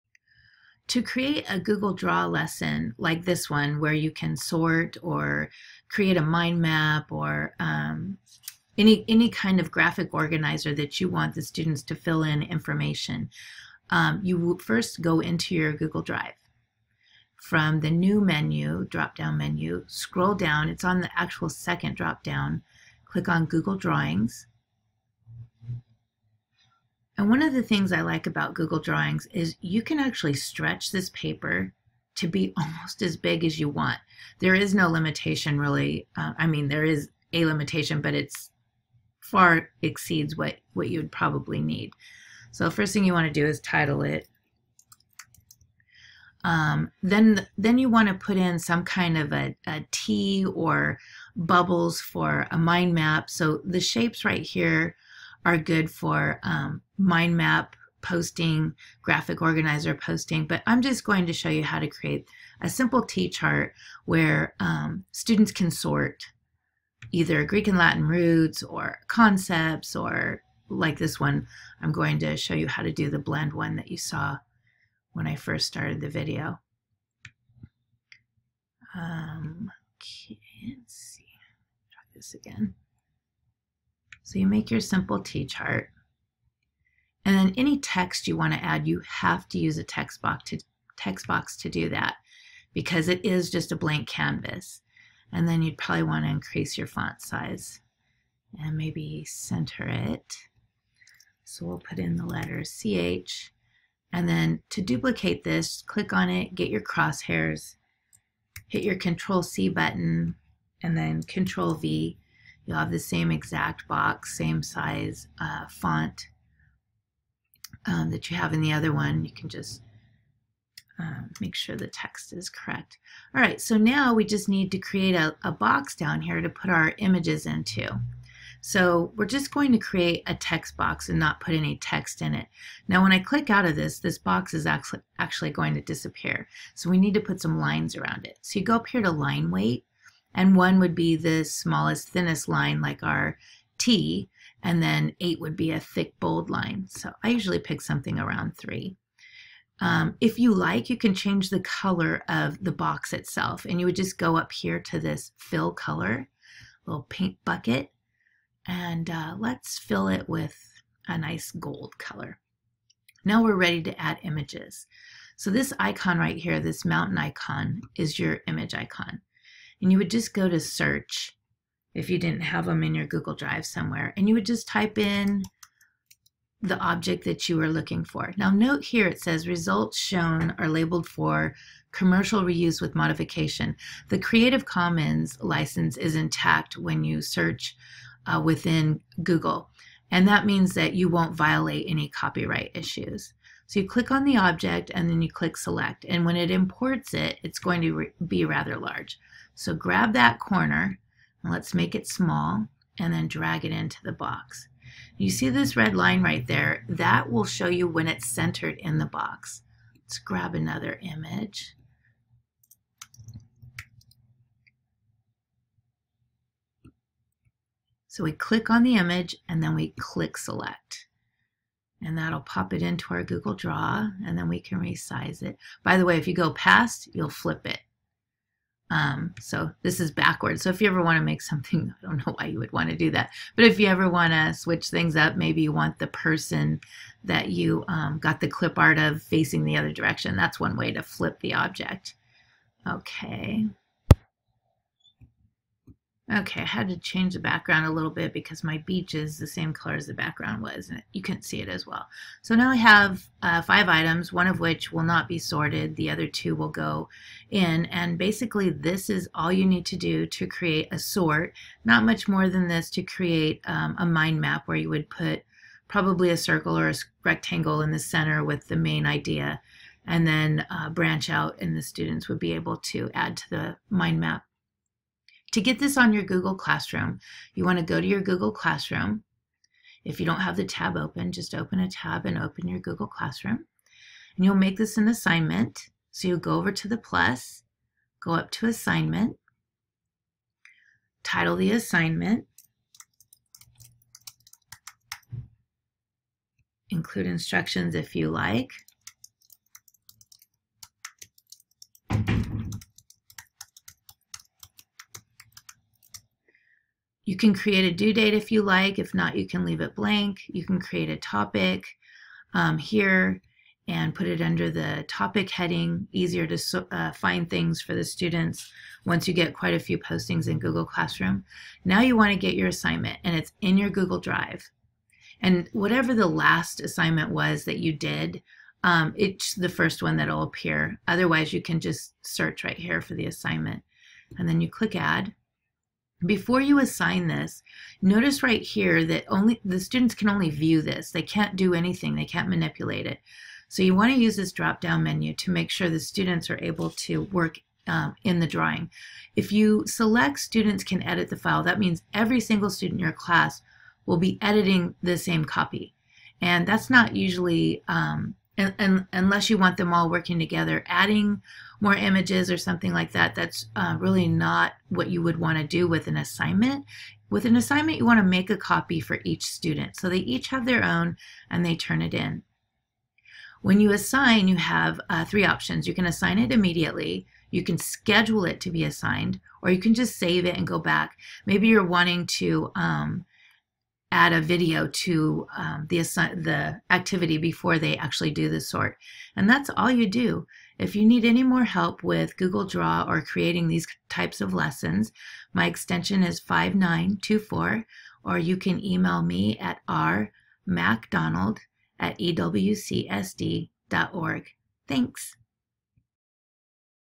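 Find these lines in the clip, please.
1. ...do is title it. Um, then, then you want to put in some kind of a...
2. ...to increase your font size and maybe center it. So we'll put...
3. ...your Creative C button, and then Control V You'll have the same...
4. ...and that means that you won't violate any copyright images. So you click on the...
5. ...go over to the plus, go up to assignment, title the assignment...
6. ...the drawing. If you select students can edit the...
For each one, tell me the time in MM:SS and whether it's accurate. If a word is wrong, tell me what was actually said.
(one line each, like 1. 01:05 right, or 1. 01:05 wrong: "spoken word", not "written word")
1. 00:43 right
2. 01:36 right
3. 01:48 wrong: "Control", not "Creative"
4. 03:10 wrong: "issues", not "images"
5. 04:46 right
6. 05:48 right.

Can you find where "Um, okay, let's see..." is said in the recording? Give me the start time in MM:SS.
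01:18.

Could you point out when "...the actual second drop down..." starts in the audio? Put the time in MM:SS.
00:20.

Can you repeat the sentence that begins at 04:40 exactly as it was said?
If you don't have the tab open, just open a tab and open your Google Classroom.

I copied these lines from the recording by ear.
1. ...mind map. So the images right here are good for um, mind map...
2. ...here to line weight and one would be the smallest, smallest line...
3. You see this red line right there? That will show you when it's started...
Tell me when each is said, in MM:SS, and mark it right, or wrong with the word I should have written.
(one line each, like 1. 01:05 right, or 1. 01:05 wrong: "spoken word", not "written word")
1. 00:52 wrong: "shapes", not "images"
2. 02:18 wrong: "thinnest", not "smallest"
3. 03:25 wrong: "centered", not "started".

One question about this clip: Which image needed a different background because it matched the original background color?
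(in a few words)
Beach.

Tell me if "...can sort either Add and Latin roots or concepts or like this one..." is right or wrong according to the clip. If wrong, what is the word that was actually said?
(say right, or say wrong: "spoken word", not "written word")
wrong: "Greek", not "Add".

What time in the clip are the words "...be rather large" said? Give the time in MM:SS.
03:18.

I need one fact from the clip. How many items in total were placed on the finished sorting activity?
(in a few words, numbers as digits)
5.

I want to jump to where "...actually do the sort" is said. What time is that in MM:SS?
06:27.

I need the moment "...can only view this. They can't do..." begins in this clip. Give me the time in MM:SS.
05:40.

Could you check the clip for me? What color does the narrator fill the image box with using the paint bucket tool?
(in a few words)
Gold.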